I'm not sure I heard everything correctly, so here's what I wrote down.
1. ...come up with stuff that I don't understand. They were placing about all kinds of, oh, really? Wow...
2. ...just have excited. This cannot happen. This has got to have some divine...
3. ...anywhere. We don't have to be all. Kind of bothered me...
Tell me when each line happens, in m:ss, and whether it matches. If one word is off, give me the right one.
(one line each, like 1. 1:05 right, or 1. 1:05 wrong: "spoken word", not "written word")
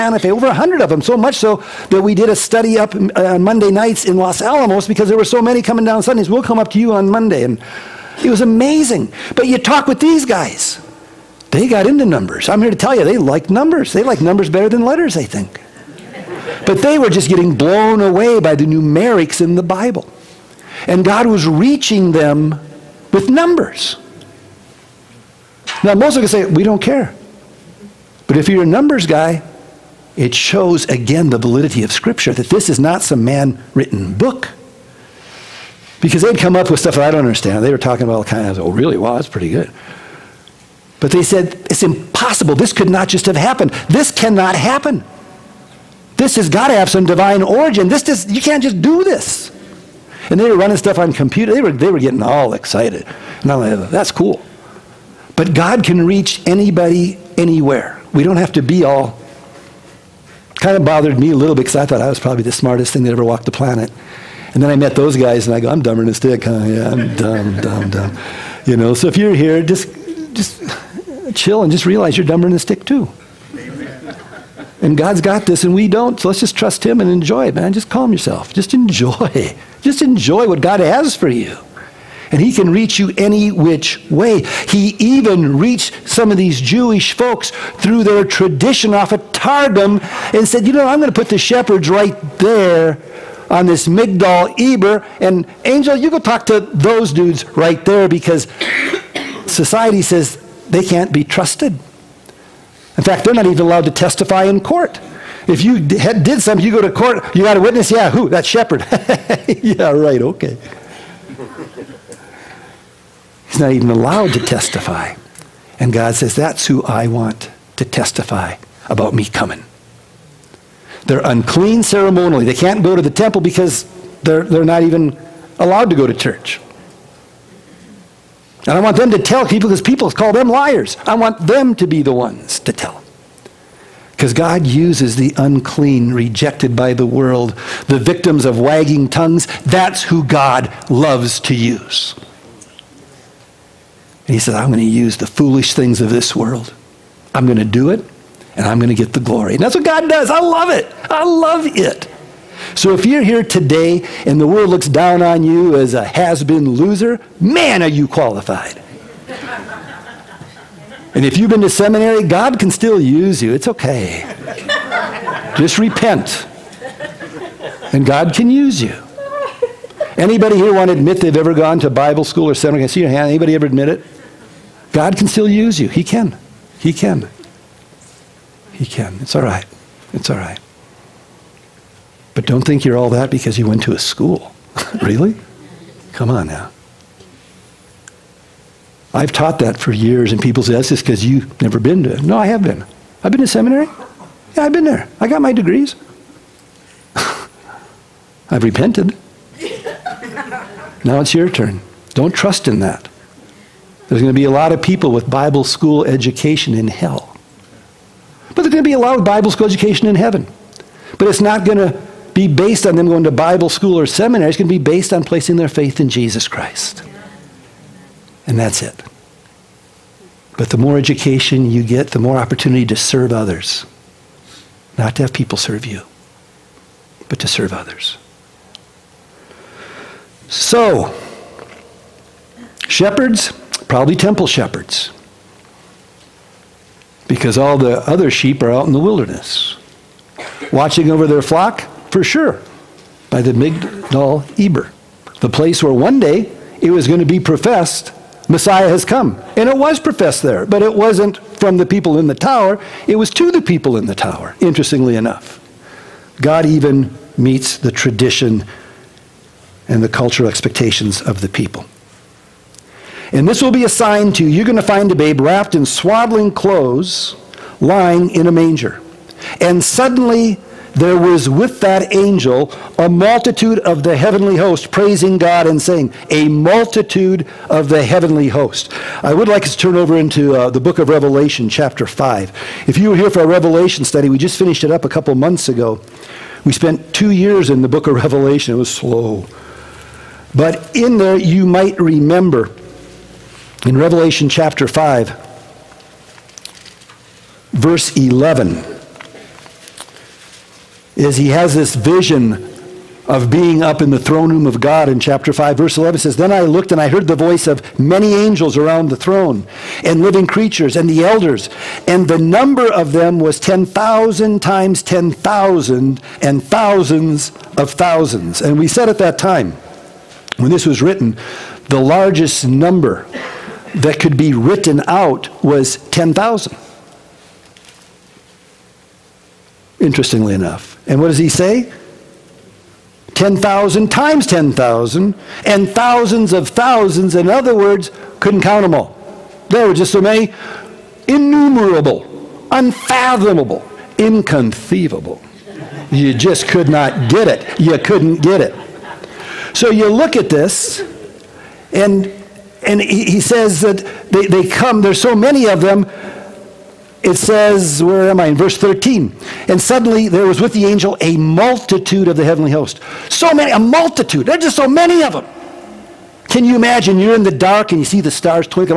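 1. 0:36 wrong: "talking", not "placing"
2. 0:43 wrong: "happened", not "excited"
3. 0:57 right.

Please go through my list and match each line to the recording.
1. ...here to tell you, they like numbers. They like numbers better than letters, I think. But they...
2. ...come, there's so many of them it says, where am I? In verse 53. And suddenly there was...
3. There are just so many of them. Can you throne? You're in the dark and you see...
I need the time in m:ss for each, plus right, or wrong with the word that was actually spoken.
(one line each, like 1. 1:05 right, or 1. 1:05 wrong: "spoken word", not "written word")
1. 0:12 right
2. 5:54 wrong: "13", not "53"
3. 6:04 wrong: "imagine", not "throne".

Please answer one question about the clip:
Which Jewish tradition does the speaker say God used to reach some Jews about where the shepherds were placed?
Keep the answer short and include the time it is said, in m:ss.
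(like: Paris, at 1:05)
Targum, at 1:29.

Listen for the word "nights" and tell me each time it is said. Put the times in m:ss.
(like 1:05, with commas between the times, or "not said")
0:03.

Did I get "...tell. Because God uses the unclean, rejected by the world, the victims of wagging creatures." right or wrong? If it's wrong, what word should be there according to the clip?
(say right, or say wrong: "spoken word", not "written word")
wrong: "tongues", not "creatures".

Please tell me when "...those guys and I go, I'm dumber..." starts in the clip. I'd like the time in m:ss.
1:04.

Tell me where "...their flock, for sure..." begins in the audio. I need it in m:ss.
4:01.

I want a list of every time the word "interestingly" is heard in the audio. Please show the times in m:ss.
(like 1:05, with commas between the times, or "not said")
4:14, 5:29.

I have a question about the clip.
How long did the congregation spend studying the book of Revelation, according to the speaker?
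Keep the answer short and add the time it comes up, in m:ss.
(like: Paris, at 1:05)
2 years, at 4:47.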